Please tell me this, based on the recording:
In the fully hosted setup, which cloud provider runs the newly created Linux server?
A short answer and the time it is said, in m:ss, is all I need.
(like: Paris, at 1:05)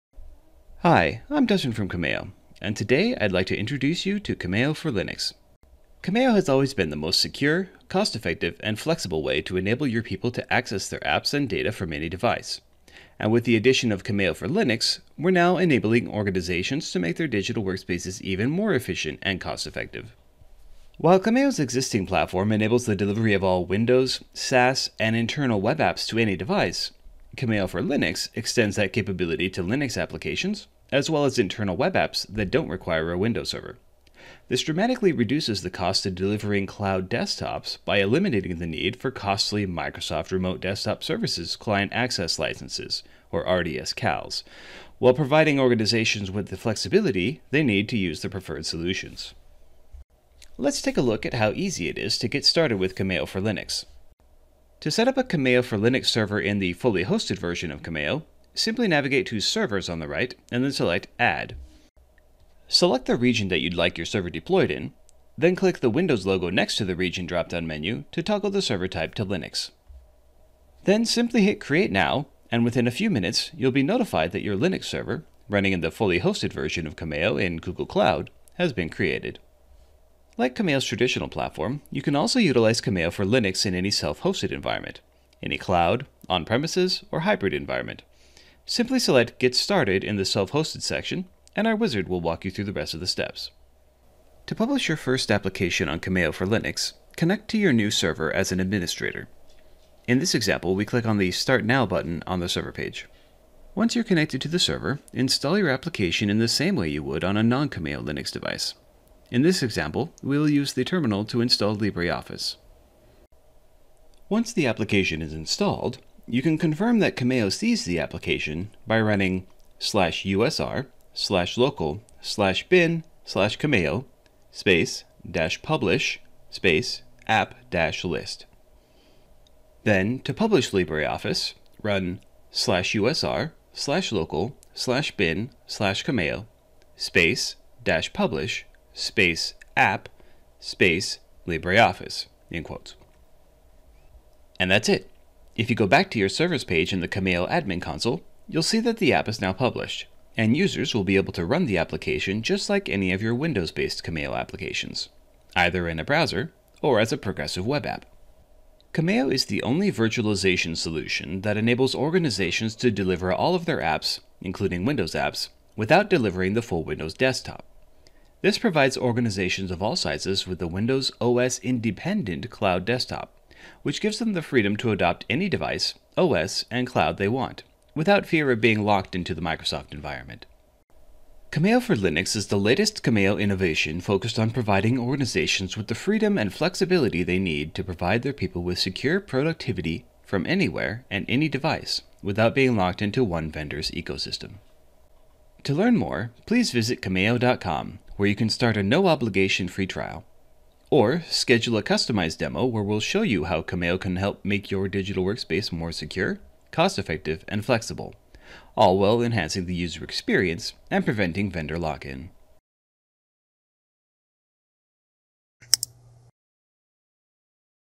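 Google Cloud, at 1:17.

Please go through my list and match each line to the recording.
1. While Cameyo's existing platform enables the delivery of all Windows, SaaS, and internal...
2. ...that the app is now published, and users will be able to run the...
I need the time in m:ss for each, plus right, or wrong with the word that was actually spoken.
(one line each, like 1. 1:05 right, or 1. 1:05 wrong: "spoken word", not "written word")
1. 0:20 right
2. 2:28 right.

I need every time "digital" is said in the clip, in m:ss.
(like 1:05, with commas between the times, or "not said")
0:17, 3:24.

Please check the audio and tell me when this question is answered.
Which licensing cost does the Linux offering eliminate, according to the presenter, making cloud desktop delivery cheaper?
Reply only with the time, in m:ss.
0:43.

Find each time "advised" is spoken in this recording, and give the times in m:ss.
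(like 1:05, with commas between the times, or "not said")
not said.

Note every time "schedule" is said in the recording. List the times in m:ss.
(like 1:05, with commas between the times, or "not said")
3:21.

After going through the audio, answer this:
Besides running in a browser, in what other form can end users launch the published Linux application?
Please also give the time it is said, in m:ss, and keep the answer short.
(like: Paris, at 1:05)
progressive web app, at 2:37.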